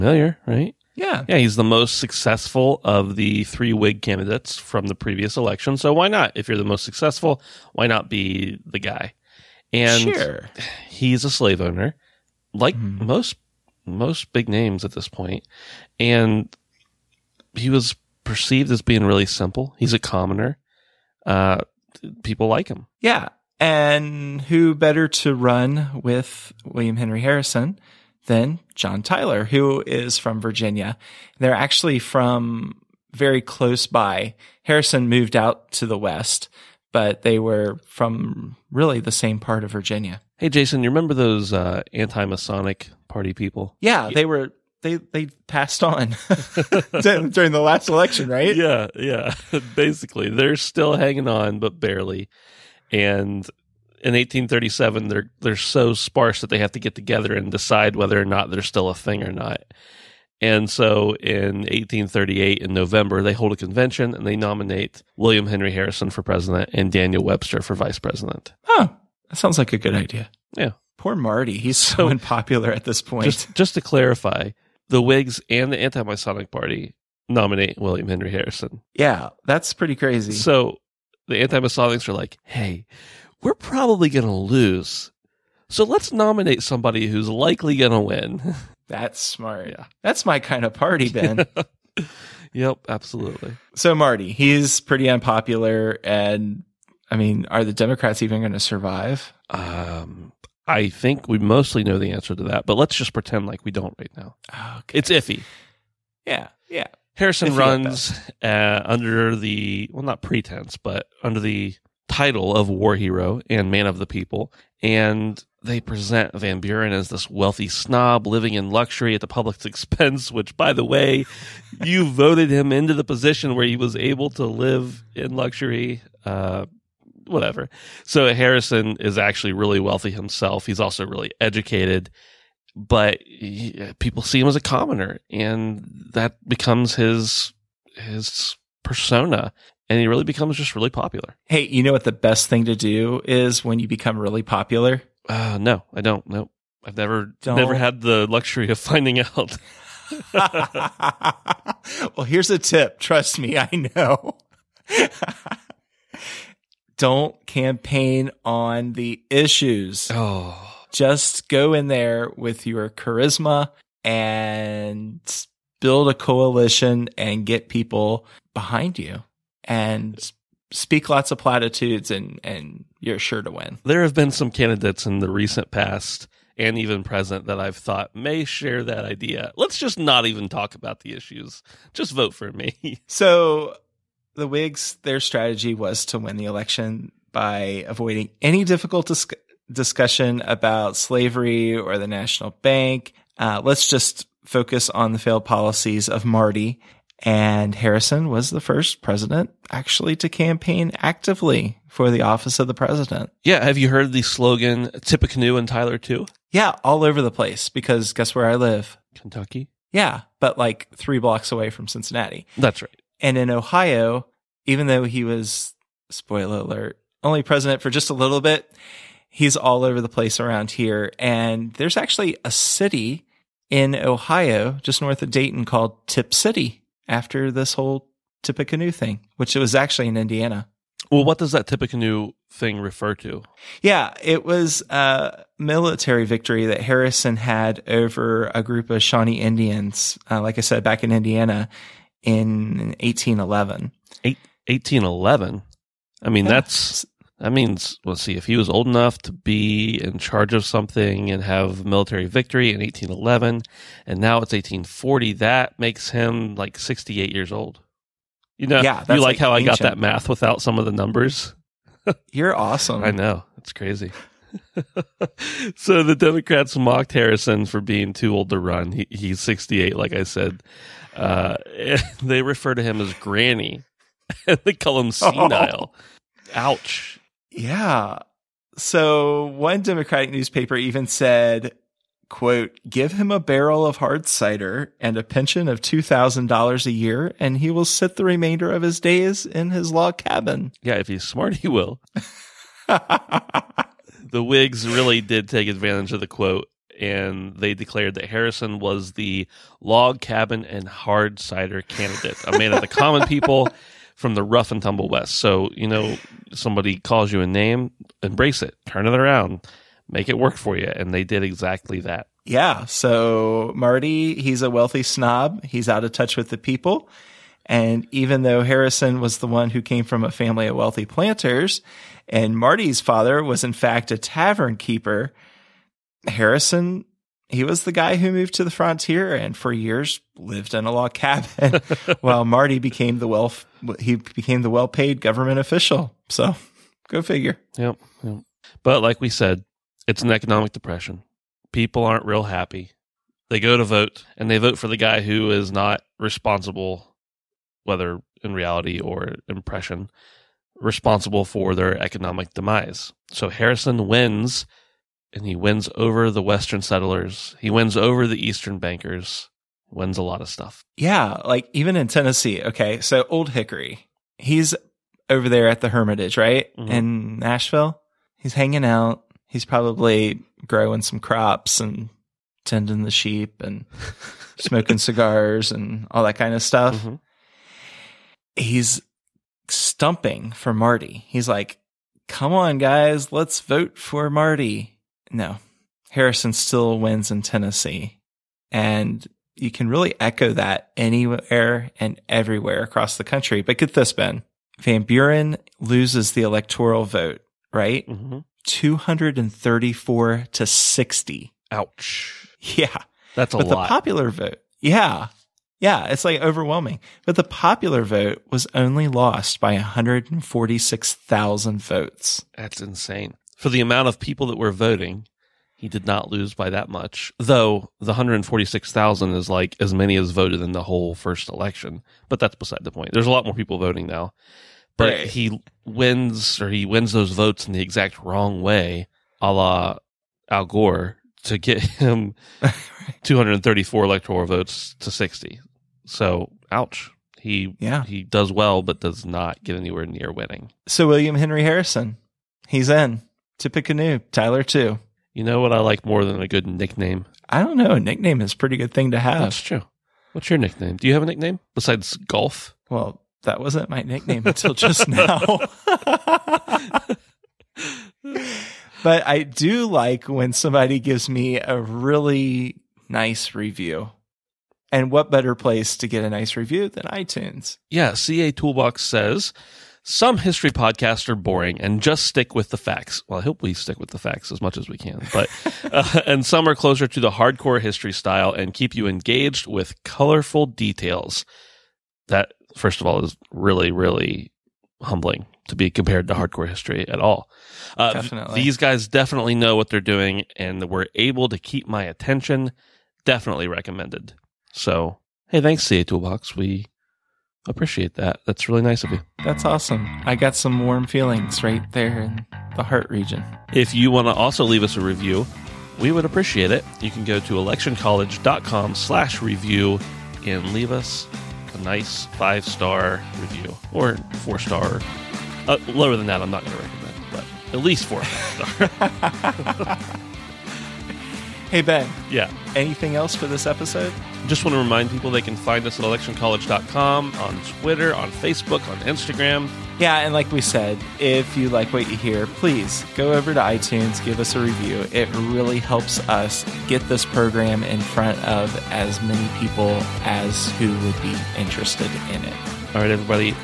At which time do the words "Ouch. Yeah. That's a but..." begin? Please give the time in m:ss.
6:41.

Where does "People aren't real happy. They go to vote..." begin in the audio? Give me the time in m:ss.
5:41.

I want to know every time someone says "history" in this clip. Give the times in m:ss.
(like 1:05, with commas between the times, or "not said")
7:50, 7:57, 8:06.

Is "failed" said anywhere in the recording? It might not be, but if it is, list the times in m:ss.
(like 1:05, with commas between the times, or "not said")
3:15.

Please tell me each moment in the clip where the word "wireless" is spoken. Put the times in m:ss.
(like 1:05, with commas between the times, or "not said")
not said.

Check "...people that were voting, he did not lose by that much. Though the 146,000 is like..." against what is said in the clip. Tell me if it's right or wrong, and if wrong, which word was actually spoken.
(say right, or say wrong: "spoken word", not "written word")
right.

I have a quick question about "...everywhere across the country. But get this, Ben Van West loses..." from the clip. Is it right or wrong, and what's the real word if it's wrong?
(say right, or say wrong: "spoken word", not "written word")
wrong: "Buren", not "West".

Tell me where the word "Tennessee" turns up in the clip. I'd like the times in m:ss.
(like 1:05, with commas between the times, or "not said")
6:02, 6:27.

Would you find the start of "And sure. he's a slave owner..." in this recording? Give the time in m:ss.
0:09.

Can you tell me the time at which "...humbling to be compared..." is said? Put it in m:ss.
8:05.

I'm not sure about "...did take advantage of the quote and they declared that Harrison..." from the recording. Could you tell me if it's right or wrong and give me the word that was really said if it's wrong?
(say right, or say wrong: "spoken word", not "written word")
right.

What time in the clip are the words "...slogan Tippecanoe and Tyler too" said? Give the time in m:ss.
3:24.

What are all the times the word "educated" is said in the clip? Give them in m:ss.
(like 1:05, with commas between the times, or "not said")
2:11.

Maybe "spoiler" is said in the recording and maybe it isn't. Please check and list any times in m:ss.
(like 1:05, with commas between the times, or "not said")
3:36.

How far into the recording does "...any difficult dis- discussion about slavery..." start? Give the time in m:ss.
3:08.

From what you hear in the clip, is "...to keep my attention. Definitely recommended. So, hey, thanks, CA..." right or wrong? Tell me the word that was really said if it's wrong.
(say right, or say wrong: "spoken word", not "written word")
right.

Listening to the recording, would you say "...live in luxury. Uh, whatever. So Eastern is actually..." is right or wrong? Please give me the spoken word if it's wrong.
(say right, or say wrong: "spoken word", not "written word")
wrong: "Harrison", not "Eastern".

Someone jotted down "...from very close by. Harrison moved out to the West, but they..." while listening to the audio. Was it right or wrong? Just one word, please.
right.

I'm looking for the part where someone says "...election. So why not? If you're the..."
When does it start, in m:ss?
0:05.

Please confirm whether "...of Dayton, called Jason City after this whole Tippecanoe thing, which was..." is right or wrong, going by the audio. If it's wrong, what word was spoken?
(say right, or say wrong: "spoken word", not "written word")
wrong: "Tipp", not "Jason".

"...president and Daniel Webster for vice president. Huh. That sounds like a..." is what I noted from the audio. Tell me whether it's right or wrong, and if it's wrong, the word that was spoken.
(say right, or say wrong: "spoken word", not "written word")
right.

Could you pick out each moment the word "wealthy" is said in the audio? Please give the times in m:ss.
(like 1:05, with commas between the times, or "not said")
1:57, 2:09, 5:14, 5:20.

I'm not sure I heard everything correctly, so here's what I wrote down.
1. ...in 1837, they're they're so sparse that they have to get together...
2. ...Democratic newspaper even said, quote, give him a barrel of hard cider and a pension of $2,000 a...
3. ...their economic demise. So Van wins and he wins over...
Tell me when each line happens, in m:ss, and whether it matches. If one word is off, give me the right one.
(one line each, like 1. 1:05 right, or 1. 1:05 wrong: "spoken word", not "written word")
1. 0:54 right
2. 4:39 right
3. 5:51 wrong: "Harrison", not "Van".